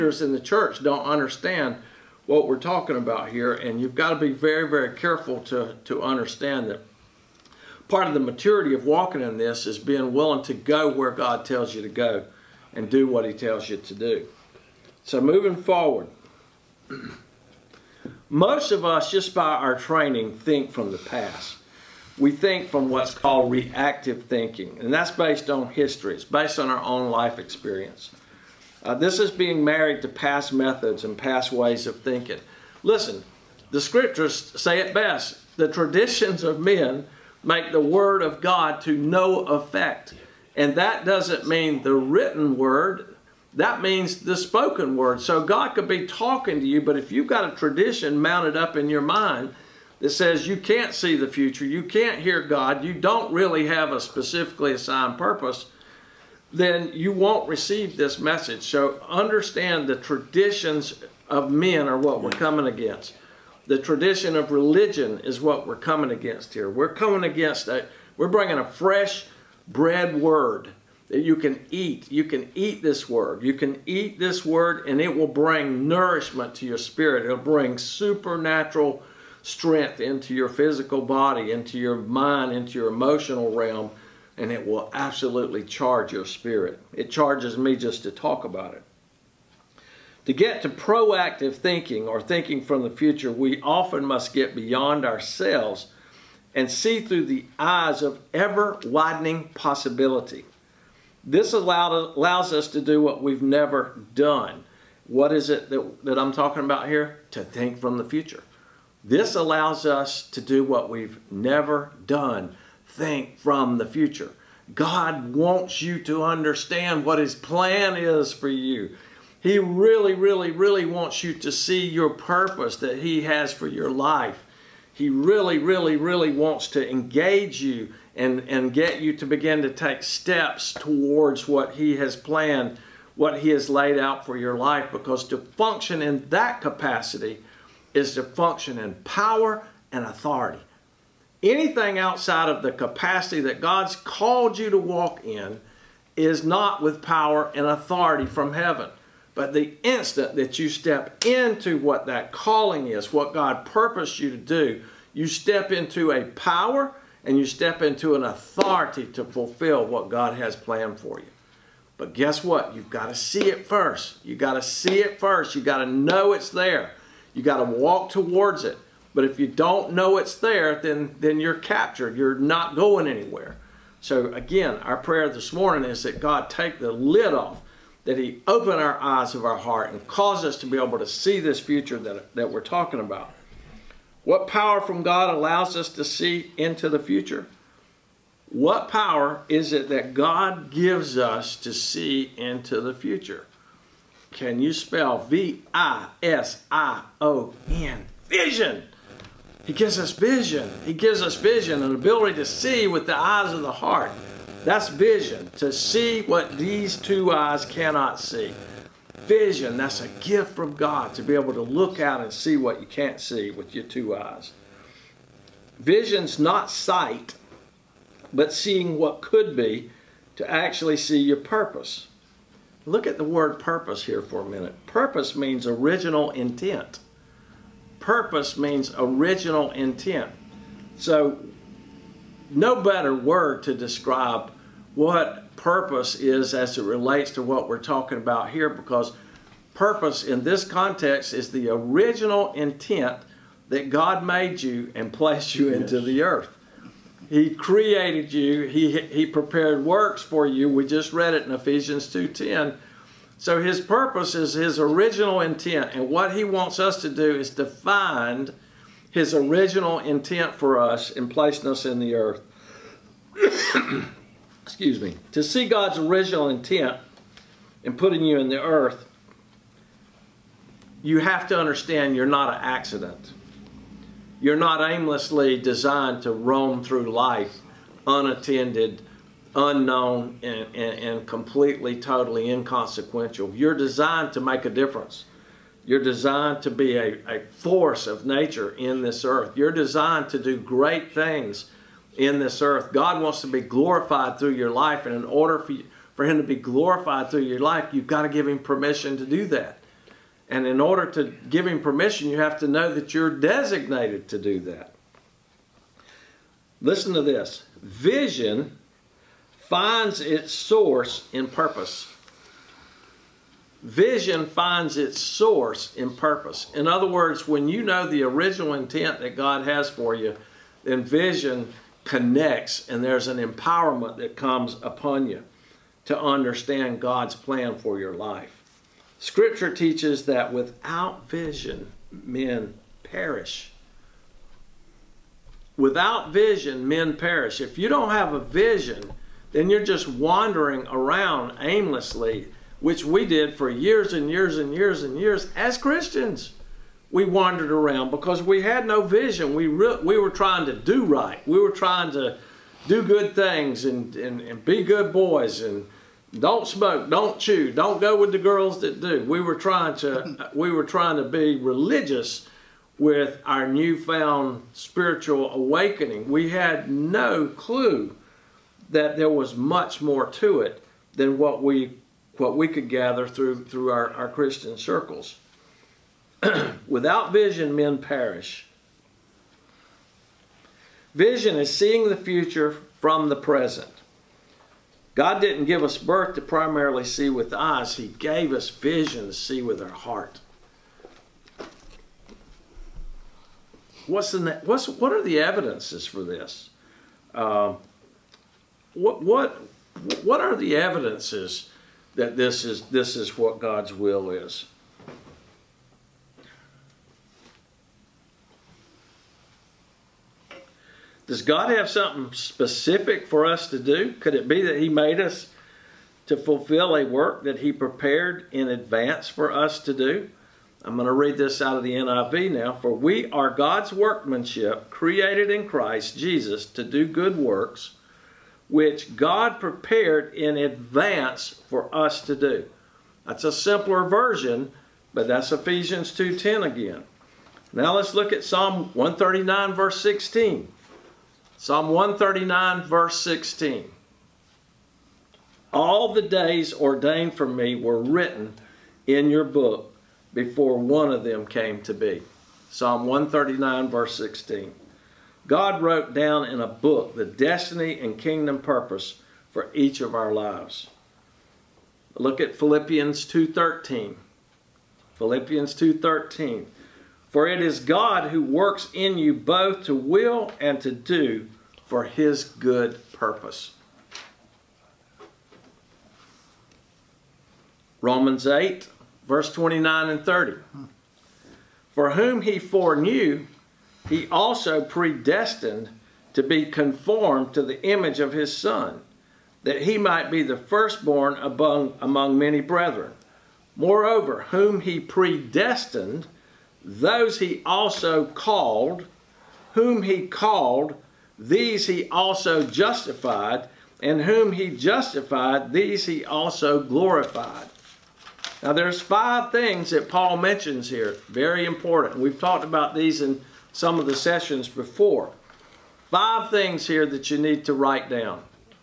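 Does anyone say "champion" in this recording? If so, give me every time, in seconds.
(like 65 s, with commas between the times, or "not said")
not said.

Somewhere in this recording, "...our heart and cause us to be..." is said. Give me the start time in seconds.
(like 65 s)
179 s.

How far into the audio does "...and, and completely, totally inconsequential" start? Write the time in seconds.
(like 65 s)
280 s.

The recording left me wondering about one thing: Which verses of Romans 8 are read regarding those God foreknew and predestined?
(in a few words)
29 and 30.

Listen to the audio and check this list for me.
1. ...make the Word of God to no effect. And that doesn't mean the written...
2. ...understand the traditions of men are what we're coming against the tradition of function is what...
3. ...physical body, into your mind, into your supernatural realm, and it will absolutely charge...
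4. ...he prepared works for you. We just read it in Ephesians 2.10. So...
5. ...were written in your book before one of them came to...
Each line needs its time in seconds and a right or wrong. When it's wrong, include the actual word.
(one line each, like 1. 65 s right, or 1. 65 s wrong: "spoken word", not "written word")
1. 37 s right
2. 59 s wrong: "religion", not "function"
3. 80 s wrong: "emotional", not "supernatural"
4. 248 s right
5. 447 s right.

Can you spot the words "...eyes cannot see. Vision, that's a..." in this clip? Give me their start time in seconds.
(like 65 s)
207 s.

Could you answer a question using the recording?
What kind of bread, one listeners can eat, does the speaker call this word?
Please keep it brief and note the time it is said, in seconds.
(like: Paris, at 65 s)
fresh bread, at 68 s.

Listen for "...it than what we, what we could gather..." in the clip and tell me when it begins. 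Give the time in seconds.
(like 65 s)
370 s.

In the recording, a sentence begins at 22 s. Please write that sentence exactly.
We think from what's called reactive thinking, and that's based on history.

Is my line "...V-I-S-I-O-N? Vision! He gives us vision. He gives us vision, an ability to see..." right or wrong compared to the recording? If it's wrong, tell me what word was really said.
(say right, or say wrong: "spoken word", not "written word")
right.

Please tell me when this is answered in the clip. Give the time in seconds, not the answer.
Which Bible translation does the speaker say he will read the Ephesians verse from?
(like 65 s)
421 s.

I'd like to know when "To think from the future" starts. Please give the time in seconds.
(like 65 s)
107 s.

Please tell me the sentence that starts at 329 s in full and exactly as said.
Scripture teaches that without vision, men perish.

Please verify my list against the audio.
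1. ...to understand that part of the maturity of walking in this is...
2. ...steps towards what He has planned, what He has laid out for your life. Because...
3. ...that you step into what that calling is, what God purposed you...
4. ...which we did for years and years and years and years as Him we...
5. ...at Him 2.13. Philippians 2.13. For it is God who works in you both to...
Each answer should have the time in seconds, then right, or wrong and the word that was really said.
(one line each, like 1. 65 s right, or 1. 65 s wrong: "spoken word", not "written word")
1. 5 s right
2. 130 s right
3. 150 s right
4. 342 s wrong: "Christians", not "Him"
5. 462 s wrong: "Philippians", not "Him".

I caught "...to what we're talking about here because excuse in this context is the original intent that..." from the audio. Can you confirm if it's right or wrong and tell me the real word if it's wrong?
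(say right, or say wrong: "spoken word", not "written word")
wrong: "purpose", not "excuse".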